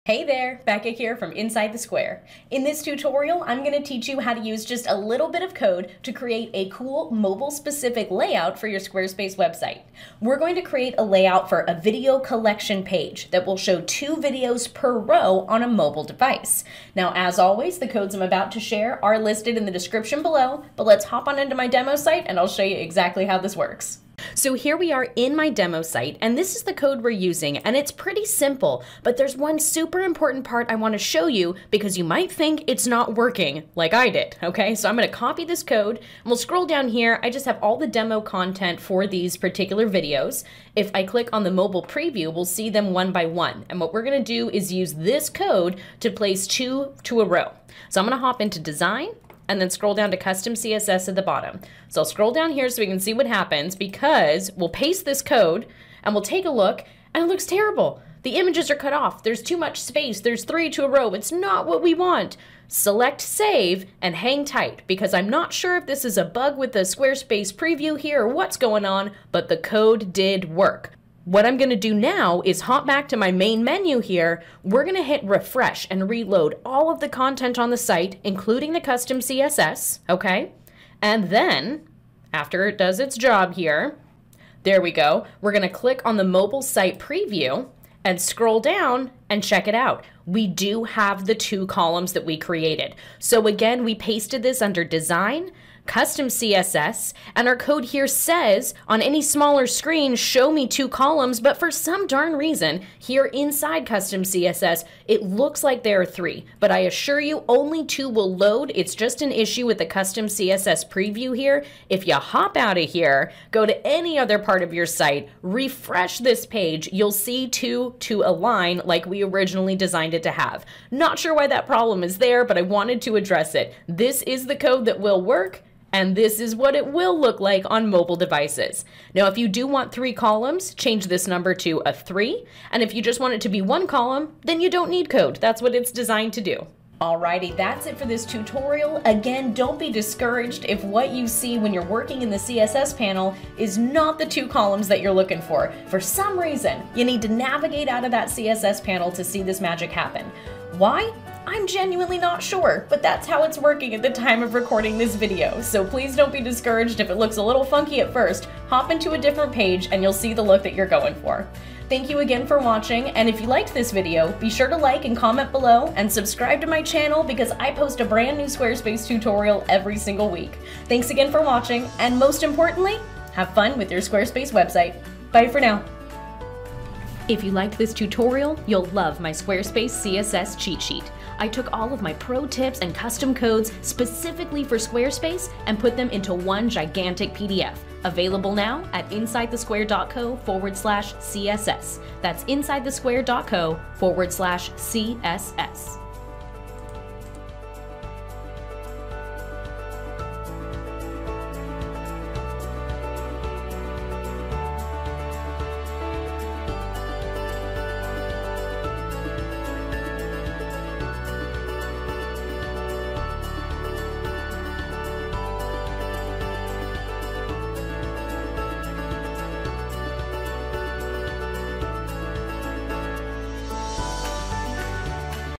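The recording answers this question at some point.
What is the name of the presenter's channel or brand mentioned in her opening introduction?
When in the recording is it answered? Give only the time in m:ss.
0:01.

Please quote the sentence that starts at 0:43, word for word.
And what we're gonna do is use this code to place two to a row.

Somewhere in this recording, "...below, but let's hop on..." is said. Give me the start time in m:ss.
0:20.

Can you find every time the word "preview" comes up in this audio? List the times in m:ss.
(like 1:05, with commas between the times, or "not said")
0:41, 1:07, 1:26, 1:50.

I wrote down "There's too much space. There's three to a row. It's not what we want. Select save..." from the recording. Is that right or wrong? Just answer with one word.
right.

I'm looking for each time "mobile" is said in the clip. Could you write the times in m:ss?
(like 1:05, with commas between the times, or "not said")
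0:07, 0:15, 0:41, 1:26, 2:07.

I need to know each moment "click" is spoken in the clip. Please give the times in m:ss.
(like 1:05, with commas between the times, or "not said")
0:41, 1:25.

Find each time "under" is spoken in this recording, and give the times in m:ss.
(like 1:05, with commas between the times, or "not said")
1:34.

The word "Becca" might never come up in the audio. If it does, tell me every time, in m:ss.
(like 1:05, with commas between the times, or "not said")
0:00.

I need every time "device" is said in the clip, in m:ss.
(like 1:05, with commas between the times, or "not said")
0:16, 2:08.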